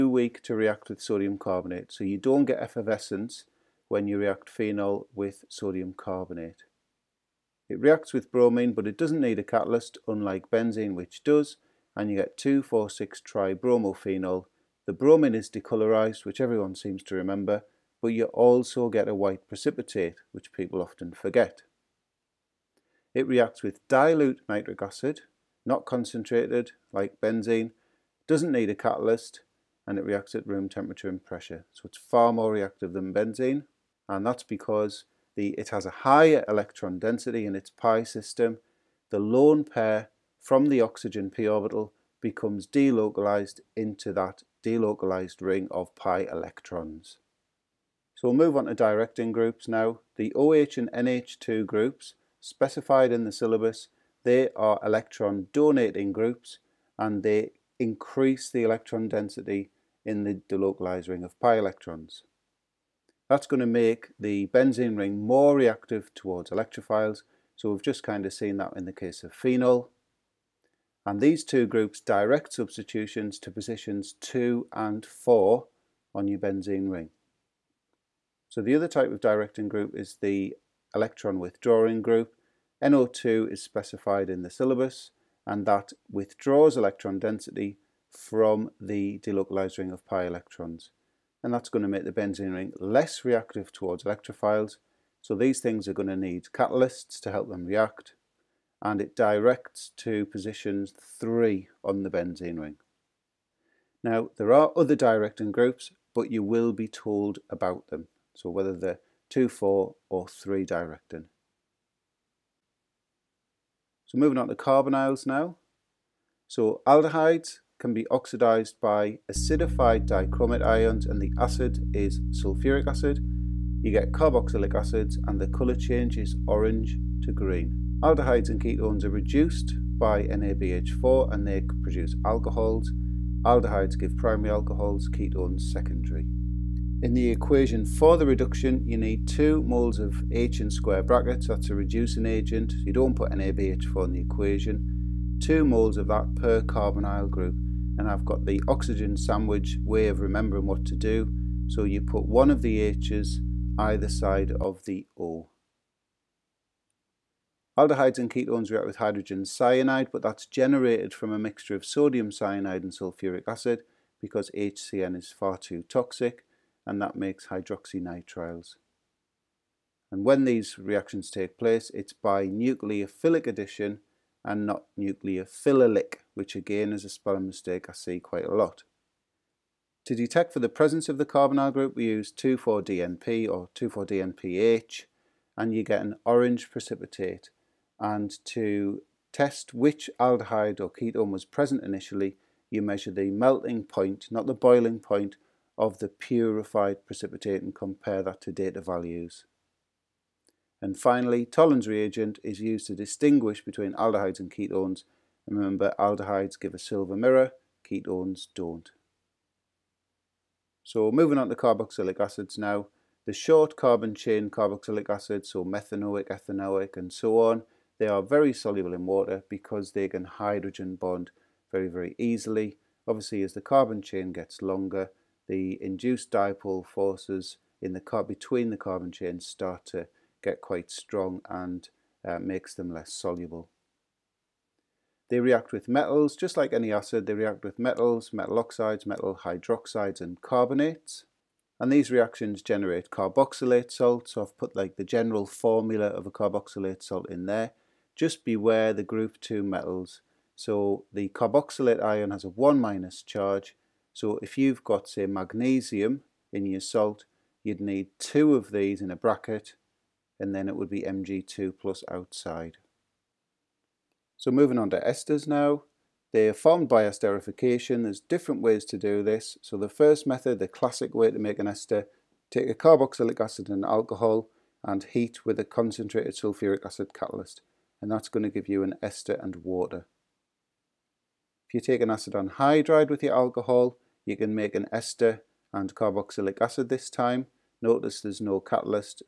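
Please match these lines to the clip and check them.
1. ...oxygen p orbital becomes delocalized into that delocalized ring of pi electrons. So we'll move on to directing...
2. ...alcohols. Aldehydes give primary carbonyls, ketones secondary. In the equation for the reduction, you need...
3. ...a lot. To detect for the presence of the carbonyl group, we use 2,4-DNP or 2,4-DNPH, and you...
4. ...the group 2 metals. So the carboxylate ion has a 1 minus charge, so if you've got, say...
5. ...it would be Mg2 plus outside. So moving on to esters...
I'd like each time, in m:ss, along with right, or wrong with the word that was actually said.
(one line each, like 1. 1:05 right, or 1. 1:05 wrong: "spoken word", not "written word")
1. 0:40 right
2. 2:12 wrong: "alcohols", not "carbonyls"
3. 2:58 right
4. 4:08 right
5. 4:20 right.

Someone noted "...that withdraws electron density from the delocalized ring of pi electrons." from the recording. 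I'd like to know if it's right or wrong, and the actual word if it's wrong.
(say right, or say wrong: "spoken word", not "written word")
right.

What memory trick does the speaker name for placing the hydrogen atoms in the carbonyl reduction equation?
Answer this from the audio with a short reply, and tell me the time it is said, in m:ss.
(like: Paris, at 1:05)
oxygen sandwich, at 2:28.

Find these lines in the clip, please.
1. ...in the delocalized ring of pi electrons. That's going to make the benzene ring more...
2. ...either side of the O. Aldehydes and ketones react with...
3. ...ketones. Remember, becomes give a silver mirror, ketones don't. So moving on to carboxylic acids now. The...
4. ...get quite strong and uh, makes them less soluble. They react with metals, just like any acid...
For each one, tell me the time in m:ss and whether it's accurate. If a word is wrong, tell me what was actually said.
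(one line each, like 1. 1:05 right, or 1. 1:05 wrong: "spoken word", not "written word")
1. 1:00 right
2. 2:33 right
3. 3:24 wrong: "aldehydes", not "becomes"
4. 3:50 right.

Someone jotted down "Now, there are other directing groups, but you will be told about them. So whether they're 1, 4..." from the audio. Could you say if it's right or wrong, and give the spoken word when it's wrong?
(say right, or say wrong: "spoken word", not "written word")
wrong: "2", not "1".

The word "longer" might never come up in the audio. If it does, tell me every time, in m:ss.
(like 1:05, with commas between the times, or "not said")
3:44.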